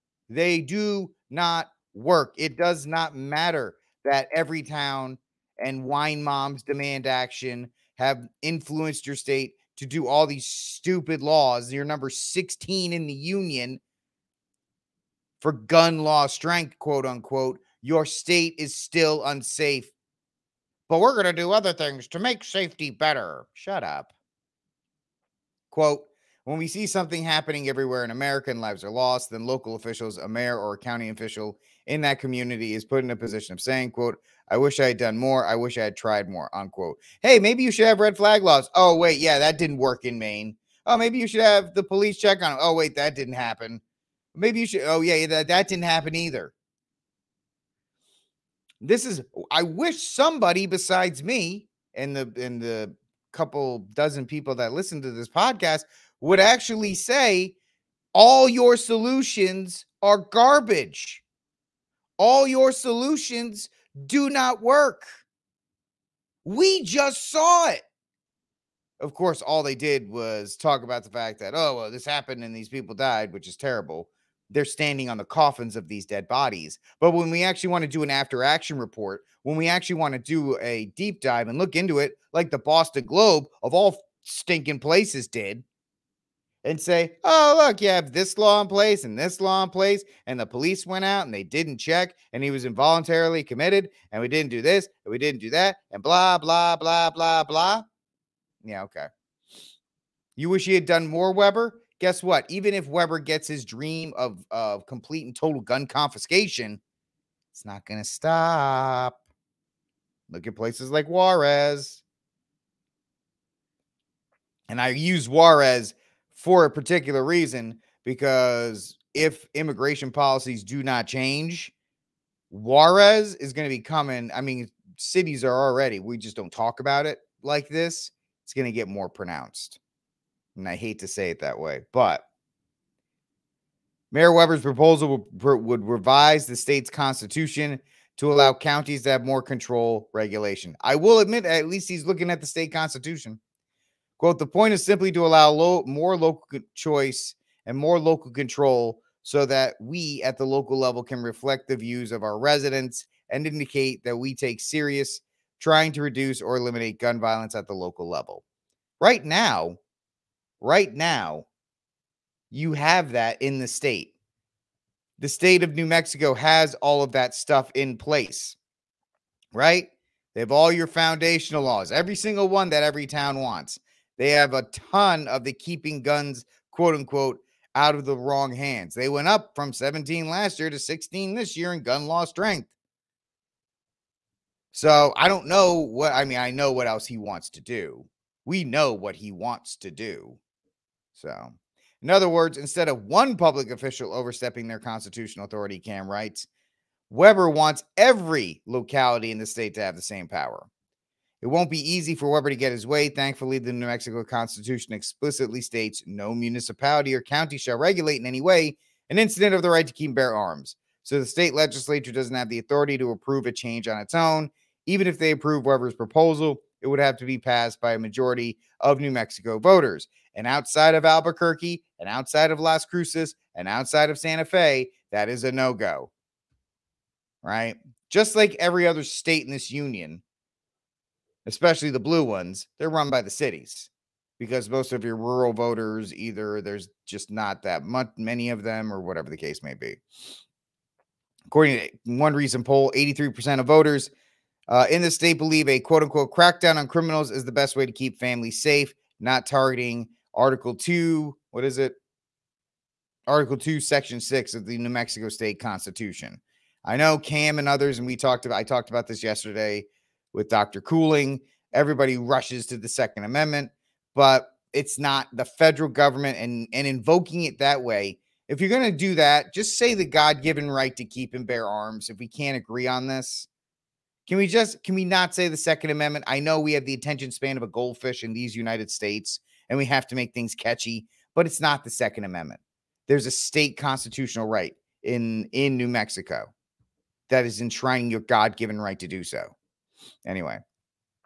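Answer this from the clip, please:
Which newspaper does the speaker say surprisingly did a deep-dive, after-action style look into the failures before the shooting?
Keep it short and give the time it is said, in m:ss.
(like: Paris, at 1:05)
The Boston Globe, at 1:22.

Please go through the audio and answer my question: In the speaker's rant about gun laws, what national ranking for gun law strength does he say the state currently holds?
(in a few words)
16.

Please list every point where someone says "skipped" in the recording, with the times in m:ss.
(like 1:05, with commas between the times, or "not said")
not said.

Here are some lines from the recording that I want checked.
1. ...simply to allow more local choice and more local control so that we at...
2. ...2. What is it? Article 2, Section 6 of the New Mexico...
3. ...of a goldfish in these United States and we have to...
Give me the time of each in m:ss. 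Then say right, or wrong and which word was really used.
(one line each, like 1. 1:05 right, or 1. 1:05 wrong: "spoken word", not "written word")
1. 2:24 right
2. 4:10 right
3. 4:37 right.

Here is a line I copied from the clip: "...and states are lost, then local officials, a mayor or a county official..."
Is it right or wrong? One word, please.
wrong.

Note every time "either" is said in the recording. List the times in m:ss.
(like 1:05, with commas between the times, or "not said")
0:46, 3:56.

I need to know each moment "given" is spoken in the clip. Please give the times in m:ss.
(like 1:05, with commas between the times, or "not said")
4:30, 4:48.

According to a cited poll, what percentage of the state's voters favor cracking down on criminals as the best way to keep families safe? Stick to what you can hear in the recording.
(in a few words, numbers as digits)
83%.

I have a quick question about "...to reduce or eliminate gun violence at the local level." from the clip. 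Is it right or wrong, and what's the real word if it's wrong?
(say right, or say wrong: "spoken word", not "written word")
right.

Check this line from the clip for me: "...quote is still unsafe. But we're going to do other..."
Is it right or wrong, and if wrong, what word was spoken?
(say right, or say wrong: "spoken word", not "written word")
wrong: "state", not "quote".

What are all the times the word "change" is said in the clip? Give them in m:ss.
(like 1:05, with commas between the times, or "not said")
2:01, 3:33.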